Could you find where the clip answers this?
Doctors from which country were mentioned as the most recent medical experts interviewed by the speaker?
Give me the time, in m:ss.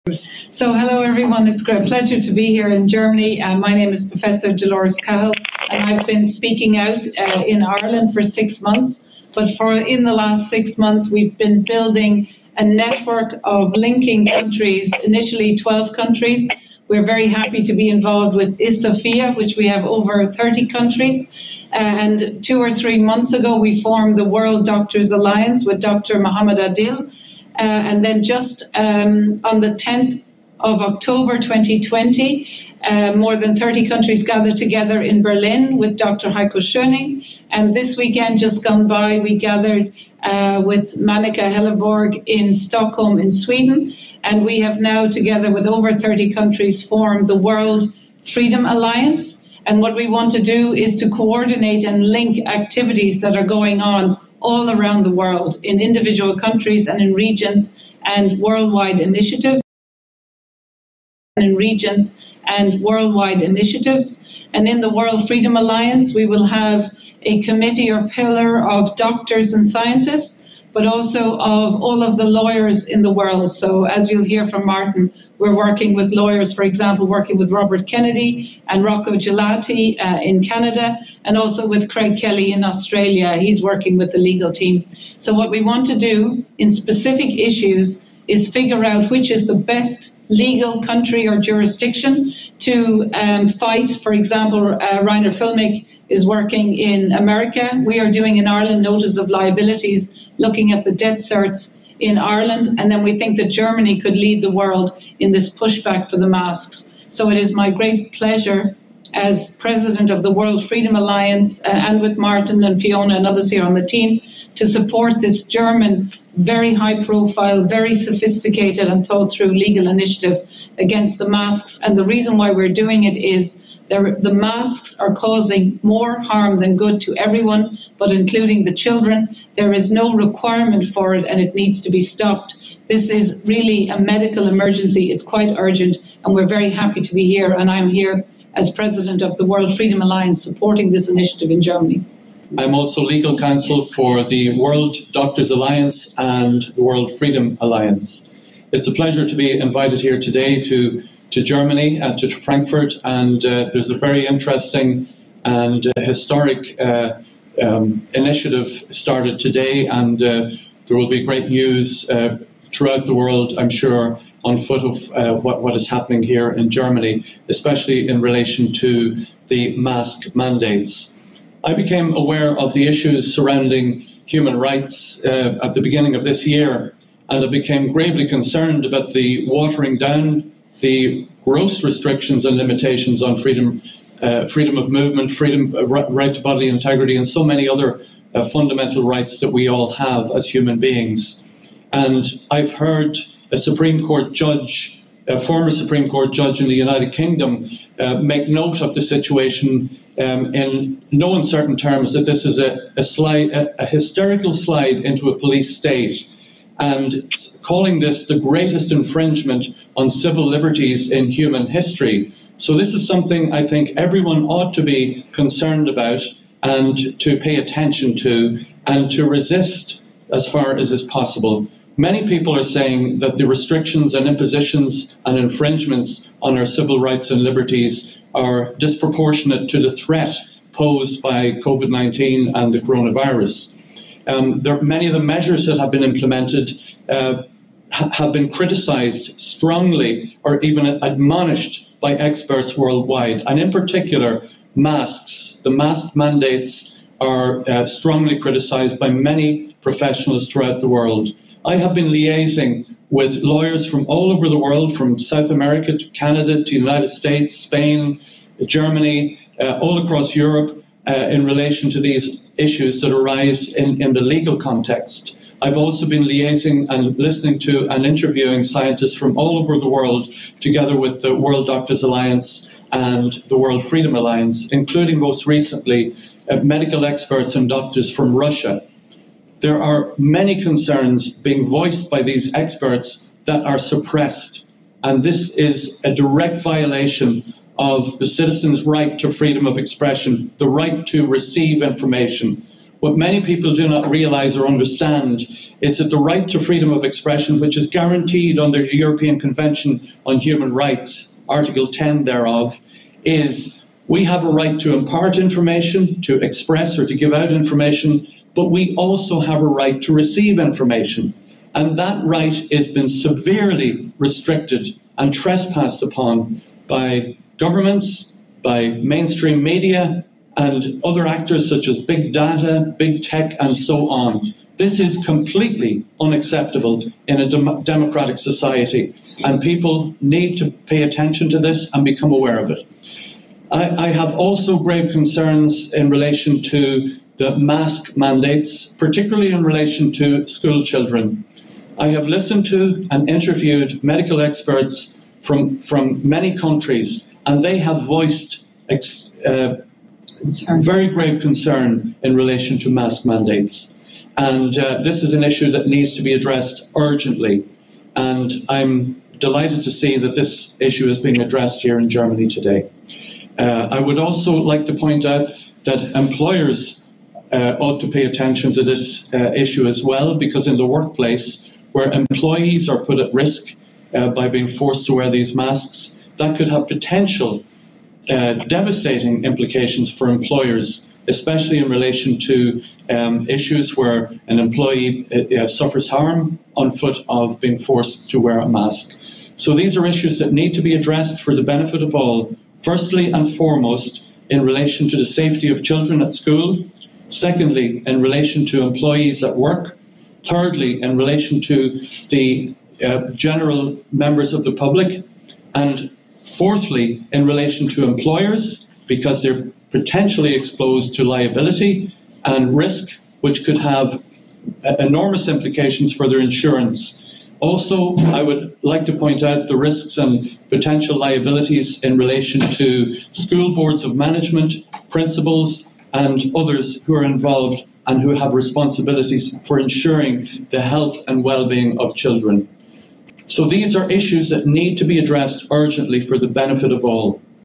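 4:38.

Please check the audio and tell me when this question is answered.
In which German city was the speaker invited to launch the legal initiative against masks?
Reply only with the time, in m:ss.
2:32.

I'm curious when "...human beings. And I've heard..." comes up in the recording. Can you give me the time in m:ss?
3:10.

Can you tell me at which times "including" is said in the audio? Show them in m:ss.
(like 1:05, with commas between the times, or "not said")
2:08, 4:34.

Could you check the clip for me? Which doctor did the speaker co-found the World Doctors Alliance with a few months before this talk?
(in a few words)
Dr. Mohammed Adil.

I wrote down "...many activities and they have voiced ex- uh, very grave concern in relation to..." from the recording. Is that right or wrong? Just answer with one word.
wrong.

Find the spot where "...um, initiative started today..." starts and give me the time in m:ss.
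2:36.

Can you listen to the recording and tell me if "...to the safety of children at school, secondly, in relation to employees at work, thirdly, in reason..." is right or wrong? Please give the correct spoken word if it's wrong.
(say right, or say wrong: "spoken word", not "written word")
wrong: "relation", not "reason".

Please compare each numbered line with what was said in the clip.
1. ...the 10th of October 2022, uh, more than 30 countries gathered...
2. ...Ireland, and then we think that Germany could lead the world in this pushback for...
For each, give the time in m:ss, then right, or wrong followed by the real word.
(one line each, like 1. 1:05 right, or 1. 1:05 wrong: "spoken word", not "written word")
1. 0:29 wrong: "2020", not "2022"
2. 1:42 right.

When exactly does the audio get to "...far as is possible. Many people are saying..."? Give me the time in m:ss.
3:40.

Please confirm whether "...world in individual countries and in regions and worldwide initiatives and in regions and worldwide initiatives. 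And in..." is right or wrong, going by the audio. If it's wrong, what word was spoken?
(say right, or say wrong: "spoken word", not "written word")
right.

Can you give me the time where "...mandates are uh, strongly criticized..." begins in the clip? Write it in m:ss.
4:06.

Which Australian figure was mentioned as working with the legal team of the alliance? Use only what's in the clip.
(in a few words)
Craig Kelly.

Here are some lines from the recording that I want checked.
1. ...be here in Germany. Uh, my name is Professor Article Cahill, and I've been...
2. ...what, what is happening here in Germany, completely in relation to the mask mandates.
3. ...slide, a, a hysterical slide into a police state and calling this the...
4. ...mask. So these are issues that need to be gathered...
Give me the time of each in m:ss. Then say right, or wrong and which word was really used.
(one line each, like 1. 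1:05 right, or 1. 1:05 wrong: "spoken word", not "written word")
1. 0:02 wrong: "Dolores", not "Article"
2. 2:45 wrong: "especially", not "completely"
3. 3:23 right
4. 6:28 wrong: "addressed", not "gathered".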